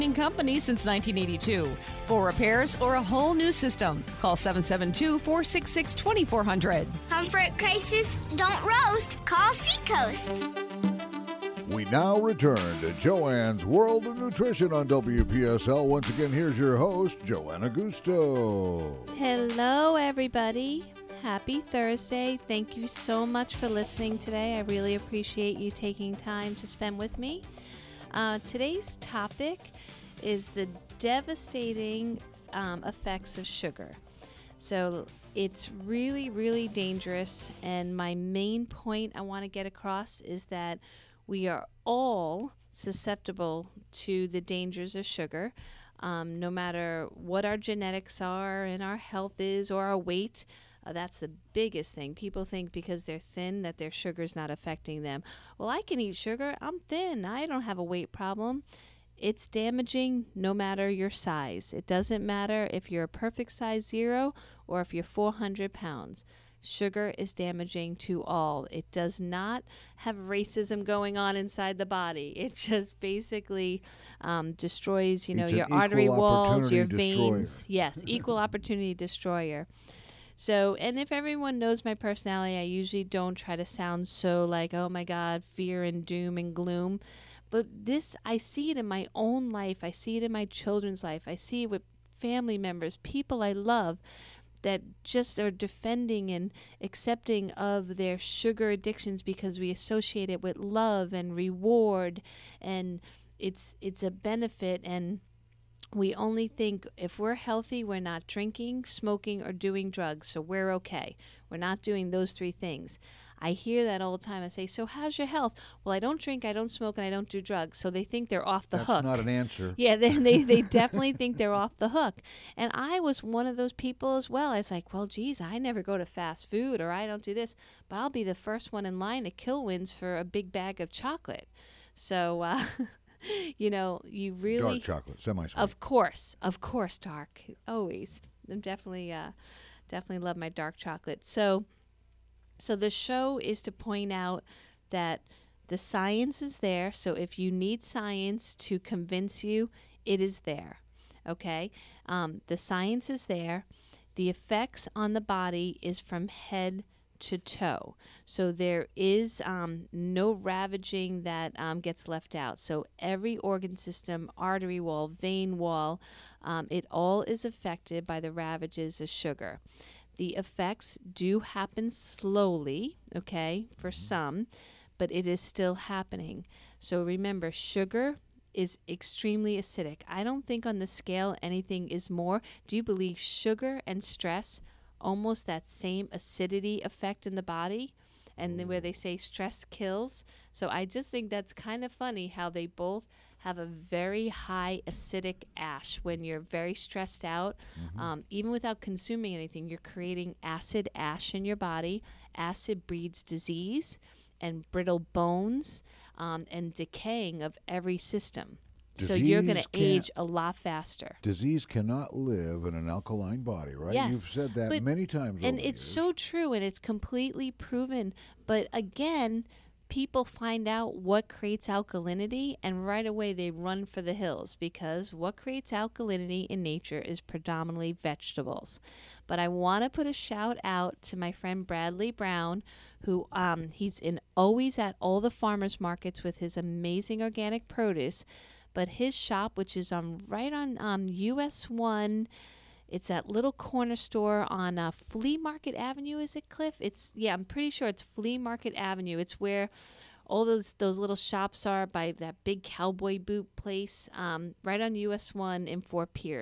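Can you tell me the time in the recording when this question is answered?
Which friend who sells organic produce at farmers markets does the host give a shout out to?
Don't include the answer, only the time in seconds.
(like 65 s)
231 s.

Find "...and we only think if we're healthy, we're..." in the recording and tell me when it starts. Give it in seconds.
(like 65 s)
104 s.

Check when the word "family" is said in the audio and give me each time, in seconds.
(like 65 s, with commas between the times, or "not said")
92 s.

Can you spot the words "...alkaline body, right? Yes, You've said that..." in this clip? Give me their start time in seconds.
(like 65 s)
212 s.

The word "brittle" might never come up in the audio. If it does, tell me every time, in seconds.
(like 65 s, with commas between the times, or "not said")
204 s.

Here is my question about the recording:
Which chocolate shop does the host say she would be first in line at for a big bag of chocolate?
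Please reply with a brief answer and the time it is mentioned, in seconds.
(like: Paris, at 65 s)
Kilwins, at 129 s.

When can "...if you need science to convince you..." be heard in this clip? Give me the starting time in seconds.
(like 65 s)
147 s.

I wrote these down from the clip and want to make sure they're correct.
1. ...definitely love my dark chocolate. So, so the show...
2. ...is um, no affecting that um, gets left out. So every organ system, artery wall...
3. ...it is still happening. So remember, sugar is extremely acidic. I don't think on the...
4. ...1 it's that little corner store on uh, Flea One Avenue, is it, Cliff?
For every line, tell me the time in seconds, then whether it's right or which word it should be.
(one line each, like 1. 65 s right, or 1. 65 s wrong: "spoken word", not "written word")
1. 139 s right
2. 158 s wrong: "ravaging", not "affecting"
3. 175 s right
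4. 241 s wrong: "Market", not "One".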